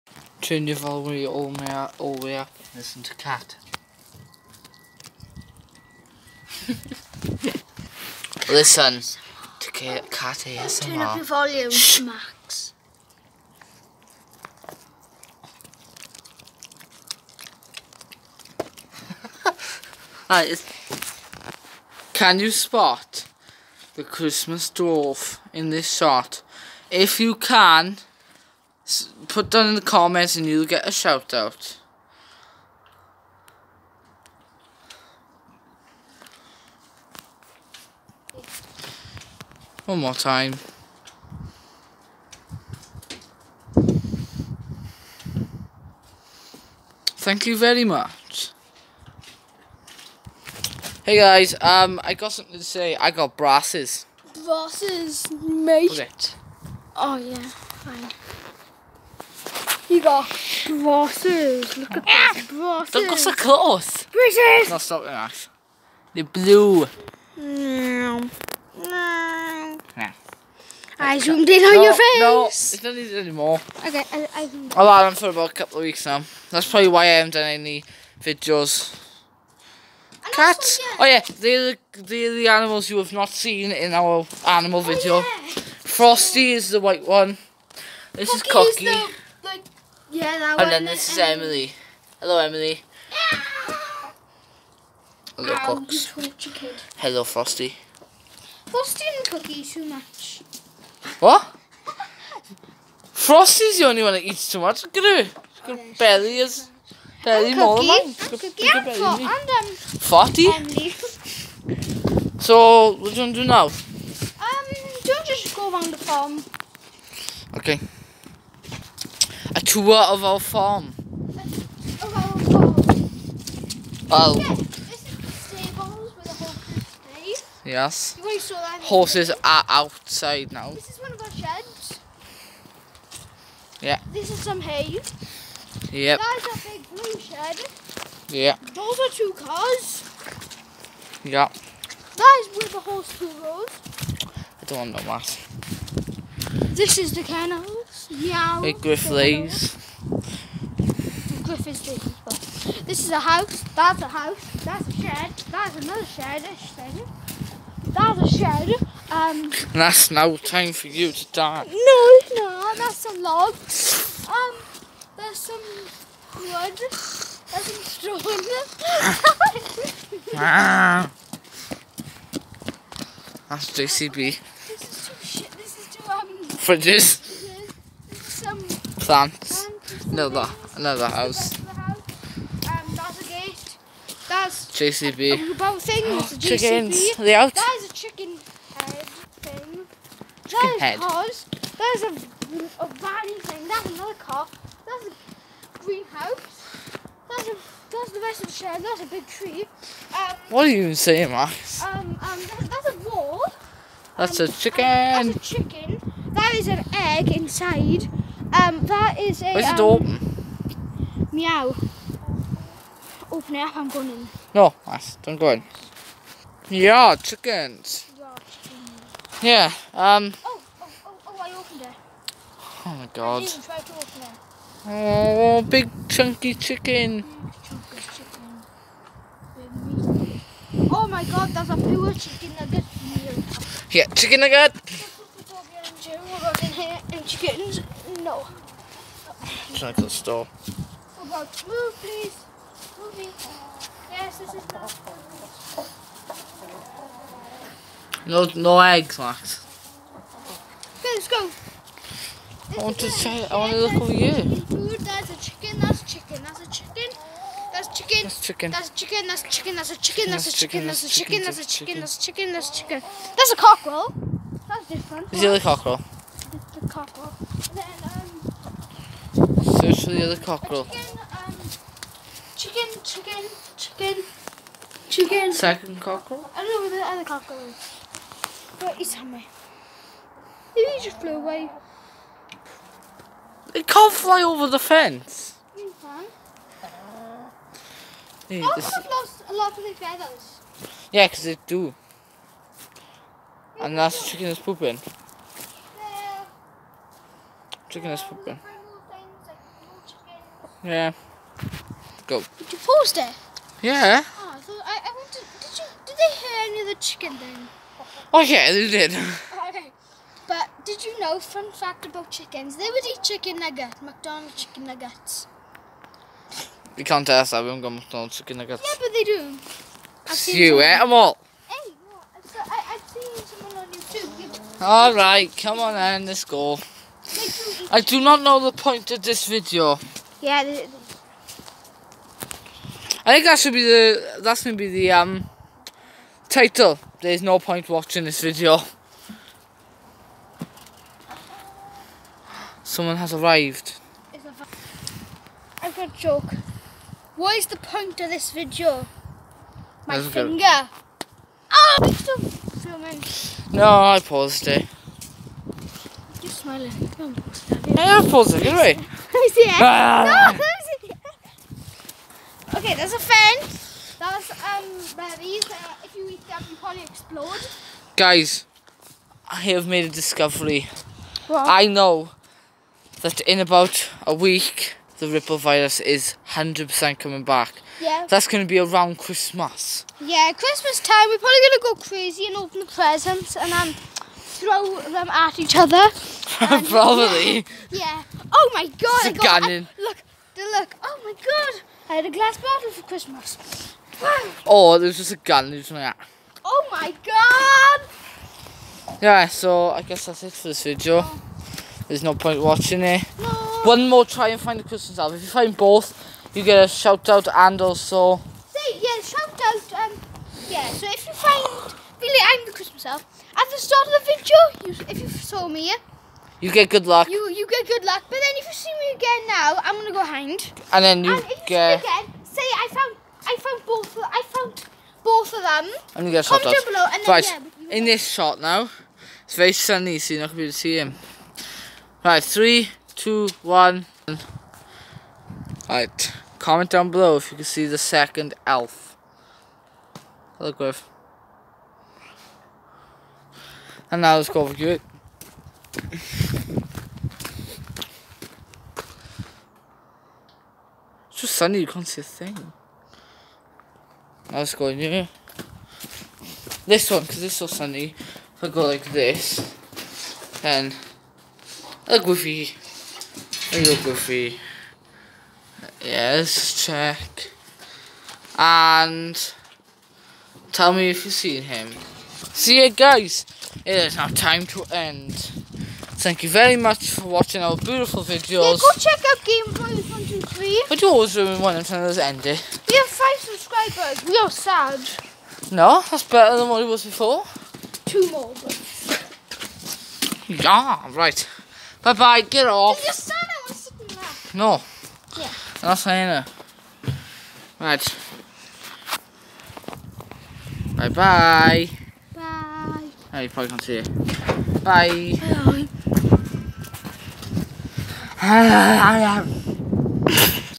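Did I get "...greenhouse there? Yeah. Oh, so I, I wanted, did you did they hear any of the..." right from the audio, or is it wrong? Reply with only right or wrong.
wrong.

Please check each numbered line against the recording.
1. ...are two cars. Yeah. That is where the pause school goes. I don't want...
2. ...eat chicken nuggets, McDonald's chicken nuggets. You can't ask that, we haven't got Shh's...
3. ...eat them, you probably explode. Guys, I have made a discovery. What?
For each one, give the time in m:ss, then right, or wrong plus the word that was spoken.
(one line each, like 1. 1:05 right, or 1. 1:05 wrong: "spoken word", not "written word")
1. 2:18 wrong: "horse", not "pause"
2. 5:13 wrong: "McDonald", not "Shh"
3. 6:06 right.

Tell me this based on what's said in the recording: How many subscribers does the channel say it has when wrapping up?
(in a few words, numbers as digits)
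5.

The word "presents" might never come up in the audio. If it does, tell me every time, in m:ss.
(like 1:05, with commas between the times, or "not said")
6:22.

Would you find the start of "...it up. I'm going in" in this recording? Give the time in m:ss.
3:33.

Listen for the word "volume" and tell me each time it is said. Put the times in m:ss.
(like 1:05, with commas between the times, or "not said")
0:00, 0:11.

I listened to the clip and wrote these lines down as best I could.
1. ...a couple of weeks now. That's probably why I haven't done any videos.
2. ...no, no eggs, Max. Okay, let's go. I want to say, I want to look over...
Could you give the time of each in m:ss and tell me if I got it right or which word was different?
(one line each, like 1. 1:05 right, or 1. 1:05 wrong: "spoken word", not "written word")
1. 1:15 right
2. 4:08 right.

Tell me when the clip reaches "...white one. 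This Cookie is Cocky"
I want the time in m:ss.
1:26.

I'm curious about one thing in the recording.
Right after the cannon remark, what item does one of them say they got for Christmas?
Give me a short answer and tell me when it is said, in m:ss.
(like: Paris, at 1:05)
Glass bottle, at 6:32.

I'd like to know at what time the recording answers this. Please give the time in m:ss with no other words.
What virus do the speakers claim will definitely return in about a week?
6:15.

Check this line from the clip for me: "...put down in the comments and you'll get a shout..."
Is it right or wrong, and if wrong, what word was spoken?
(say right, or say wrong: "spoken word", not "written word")
right.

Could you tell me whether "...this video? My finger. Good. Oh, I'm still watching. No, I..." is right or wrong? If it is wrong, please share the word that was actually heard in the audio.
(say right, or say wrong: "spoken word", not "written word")
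wrong: "filming", not "watching".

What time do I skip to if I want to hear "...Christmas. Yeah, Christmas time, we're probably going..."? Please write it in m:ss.
6:19.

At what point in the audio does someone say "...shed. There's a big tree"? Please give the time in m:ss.
3:18.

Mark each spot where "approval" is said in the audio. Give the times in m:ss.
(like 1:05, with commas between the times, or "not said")
not said.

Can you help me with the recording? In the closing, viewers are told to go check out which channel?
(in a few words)
Game 123.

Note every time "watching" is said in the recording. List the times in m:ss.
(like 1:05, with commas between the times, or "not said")
5:37, 6:42, 7:57.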